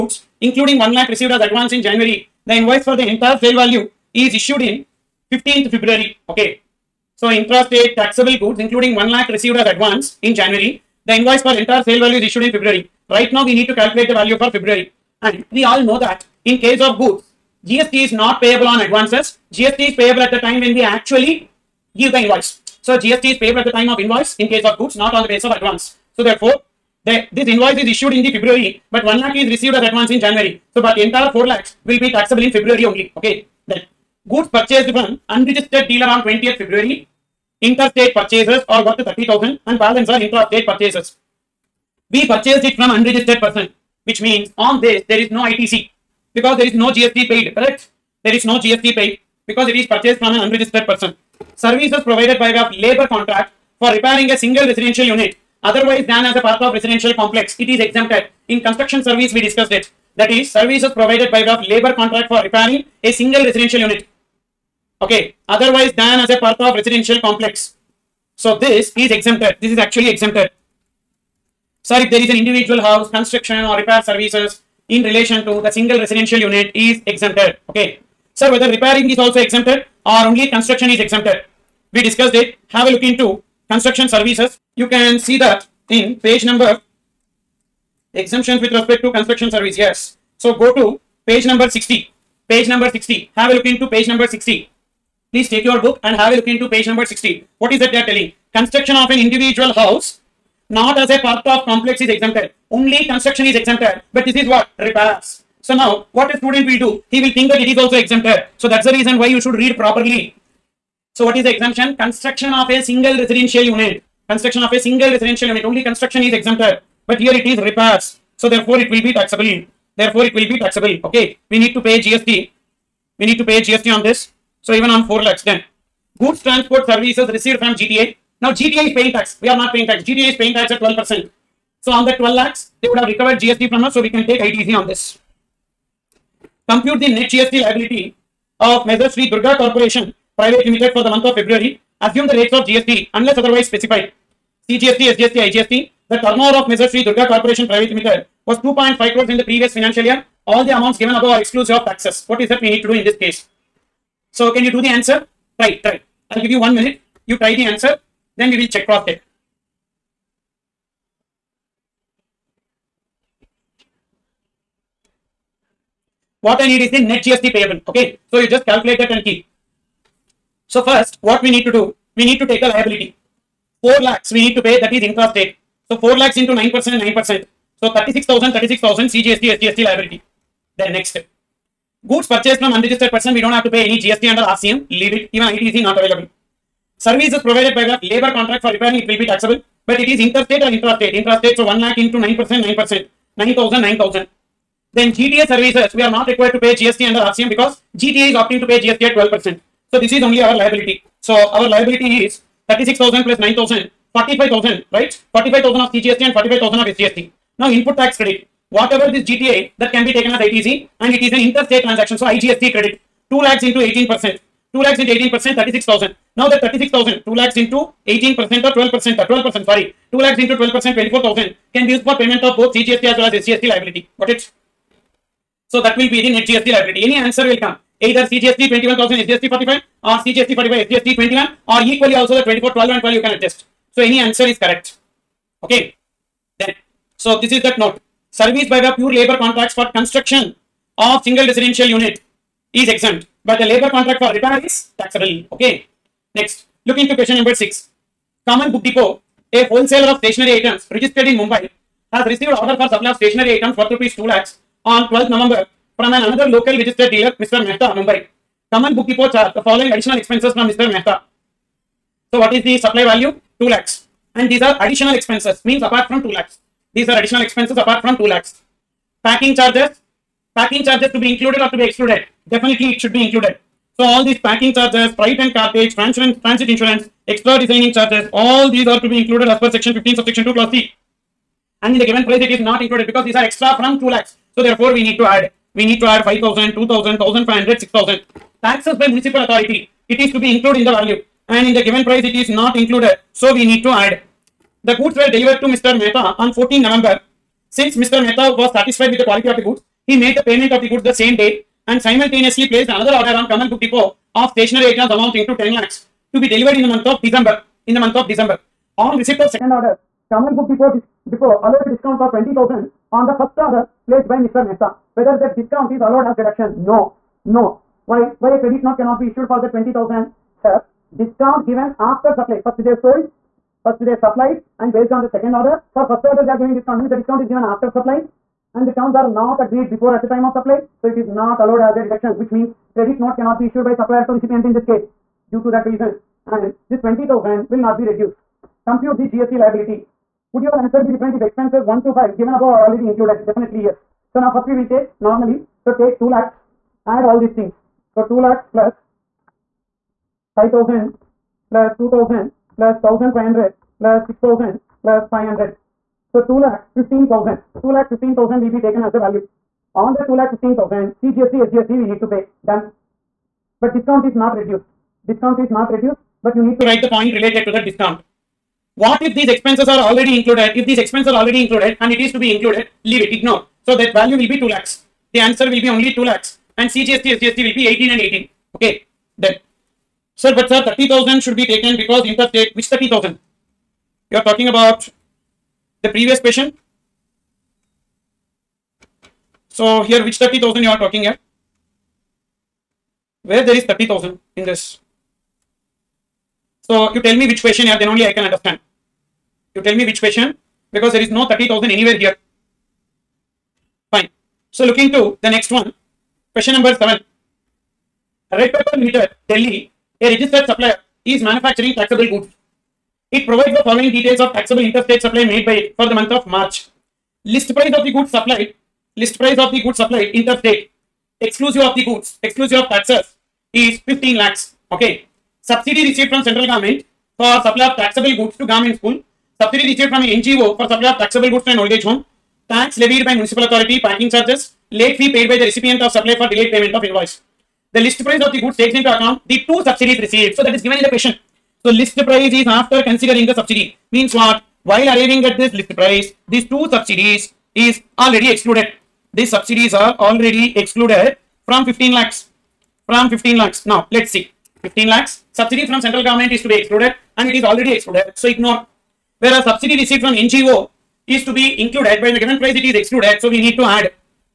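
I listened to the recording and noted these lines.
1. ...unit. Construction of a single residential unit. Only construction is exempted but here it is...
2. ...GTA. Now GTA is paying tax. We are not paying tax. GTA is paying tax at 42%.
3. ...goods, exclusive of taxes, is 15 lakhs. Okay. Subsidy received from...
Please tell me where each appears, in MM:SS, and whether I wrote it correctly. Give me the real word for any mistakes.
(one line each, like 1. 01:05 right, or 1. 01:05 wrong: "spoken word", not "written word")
1. 01:53 right
2. 02:07 wrong: "12", not "42"
3. 07:02 right.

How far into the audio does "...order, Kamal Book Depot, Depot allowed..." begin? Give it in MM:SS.
05:09.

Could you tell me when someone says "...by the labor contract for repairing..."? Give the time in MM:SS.
03:07.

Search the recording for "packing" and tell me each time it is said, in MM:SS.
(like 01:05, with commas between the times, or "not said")
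04:29, 04:34.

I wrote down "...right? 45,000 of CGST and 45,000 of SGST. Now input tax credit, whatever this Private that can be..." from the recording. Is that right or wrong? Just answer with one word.
wrong.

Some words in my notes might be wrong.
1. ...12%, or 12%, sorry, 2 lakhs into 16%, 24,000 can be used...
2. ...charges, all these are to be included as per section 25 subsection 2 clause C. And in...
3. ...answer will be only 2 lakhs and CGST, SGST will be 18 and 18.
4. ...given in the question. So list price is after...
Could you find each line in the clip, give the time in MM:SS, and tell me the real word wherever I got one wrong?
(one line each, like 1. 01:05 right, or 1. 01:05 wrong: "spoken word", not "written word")
1. 03:38 wrong: "12", not "16"
2. 04:37 wrong: "15", not "25"
3. 06:15 right
4. 07:20 right.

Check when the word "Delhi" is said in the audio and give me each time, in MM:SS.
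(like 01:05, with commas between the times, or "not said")
06:49.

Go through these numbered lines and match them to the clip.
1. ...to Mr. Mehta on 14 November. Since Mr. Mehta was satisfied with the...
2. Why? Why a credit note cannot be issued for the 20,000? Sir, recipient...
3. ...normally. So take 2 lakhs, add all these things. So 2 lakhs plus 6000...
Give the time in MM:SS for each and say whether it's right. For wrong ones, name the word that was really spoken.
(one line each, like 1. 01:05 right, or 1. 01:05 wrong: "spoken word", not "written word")
1. 04:55 right
2. 05:18 wrong: "discount", not "recipient"
3. 05:45 wrong: "5000", not "6000".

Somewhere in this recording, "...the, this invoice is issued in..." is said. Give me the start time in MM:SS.
00:27.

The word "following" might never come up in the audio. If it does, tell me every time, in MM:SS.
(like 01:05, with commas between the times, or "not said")
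04:19, 06:53.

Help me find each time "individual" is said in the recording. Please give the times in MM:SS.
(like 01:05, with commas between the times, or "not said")
01:12, 01:39.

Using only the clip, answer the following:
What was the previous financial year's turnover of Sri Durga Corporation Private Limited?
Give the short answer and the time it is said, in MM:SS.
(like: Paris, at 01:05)
2.5 crores, at 02:28.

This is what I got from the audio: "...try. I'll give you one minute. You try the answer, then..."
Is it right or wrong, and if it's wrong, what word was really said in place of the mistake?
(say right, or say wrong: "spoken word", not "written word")
right.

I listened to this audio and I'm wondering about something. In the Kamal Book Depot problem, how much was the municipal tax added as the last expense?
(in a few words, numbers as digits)
500.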